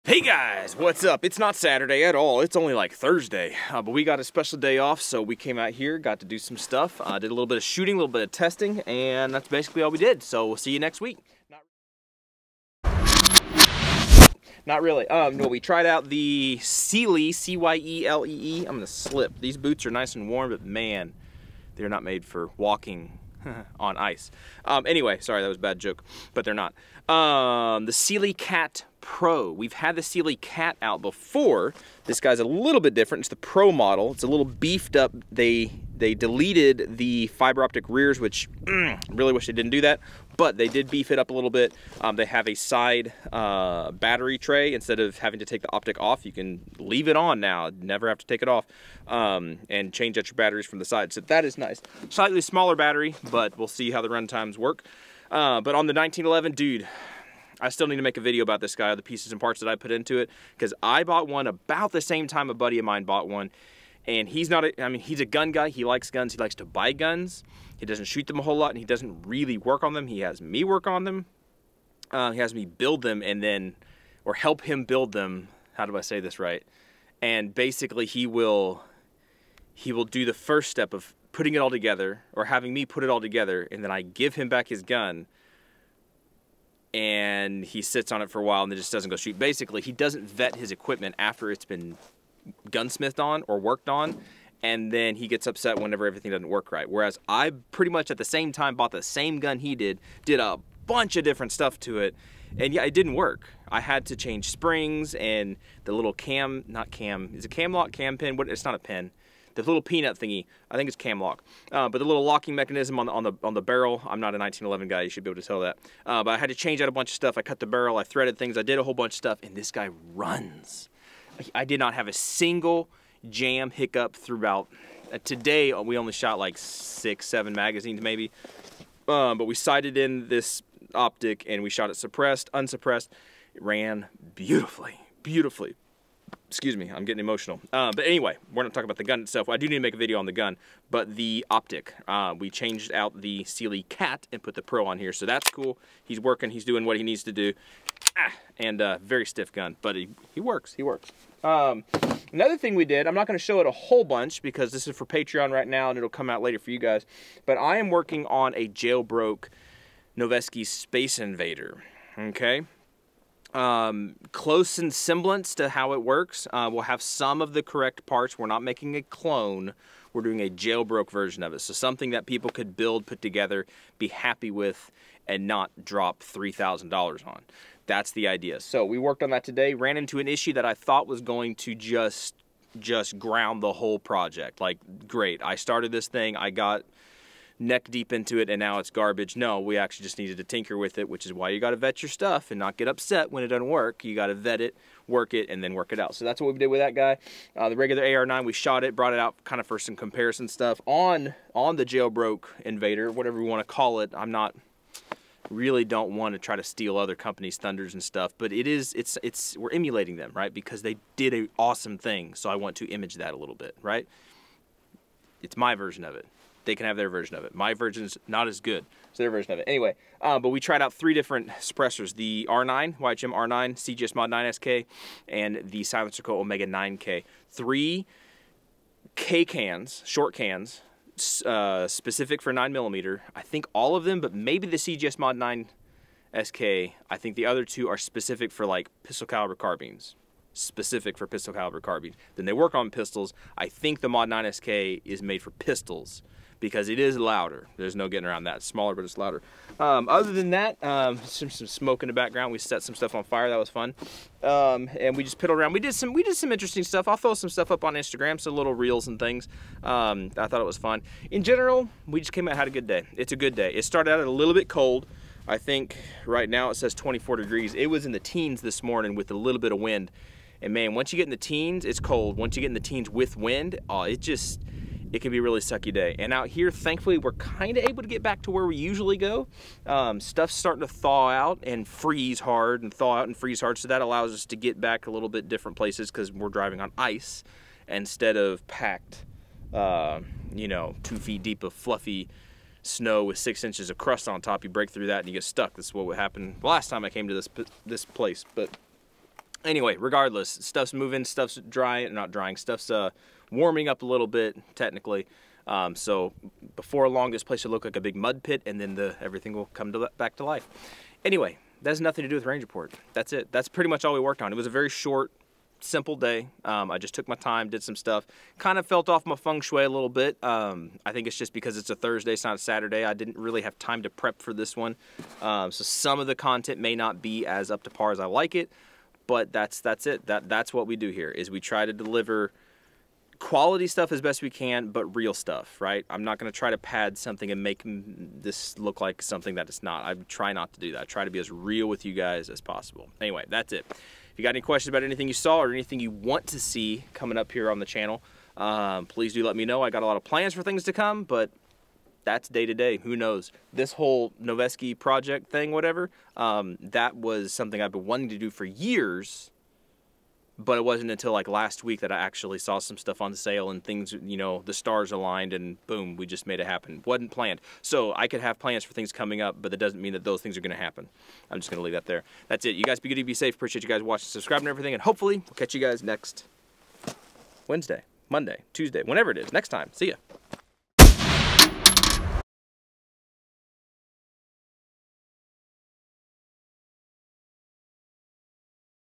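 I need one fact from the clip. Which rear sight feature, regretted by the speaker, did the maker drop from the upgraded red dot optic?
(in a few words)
fiber optic rears.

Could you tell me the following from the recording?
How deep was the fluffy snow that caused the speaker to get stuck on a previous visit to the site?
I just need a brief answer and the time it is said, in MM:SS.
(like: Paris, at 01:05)
two feet, at 04:51.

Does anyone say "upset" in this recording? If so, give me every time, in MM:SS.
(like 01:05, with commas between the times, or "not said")
01:35, 03:12.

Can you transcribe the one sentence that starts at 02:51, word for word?
So something that people could build, put together, be happy with, and not drop $3,000 on.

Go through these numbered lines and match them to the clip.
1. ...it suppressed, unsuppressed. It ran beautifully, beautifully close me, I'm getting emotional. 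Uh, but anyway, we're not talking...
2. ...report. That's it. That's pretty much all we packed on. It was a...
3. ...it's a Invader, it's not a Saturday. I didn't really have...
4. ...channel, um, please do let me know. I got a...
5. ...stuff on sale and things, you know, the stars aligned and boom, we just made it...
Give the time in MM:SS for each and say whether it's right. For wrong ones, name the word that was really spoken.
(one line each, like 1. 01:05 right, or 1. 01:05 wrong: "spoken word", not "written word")
1. 02:11 wrong: "excuse", not "close"
2. 05:12 wrong: "worked", not "packed"
3. 05:21 wrong: "Thursday", not "Invader"
4. 05:47 right
5. 06:02 right.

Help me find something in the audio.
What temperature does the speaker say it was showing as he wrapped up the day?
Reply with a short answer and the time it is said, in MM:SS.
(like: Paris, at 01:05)
24 degrees, at 04:26.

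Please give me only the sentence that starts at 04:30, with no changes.
And man, once you get in the teens, it's cold.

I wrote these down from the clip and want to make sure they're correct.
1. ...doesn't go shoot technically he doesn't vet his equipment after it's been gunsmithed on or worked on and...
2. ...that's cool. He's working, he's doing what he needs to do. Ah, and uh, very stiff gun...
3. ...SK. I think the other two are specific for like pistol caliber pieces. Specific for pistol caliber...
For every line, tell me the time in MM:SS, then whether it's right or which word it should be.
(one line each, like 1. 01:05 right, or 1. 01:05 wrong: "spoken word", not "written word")
1. 01:28 wrong: "basically", not "technically"
2. 02:25 right
3. 03:56 wrong: "carbines", not "pieces".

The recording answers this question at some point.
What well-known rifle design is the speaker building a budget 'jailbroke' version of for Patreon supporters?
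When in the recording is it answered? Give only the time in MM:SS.
02:40.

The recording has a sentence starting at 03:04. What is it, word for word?
Like, great, I started this thing, I got neck deep into it and now it's garbage.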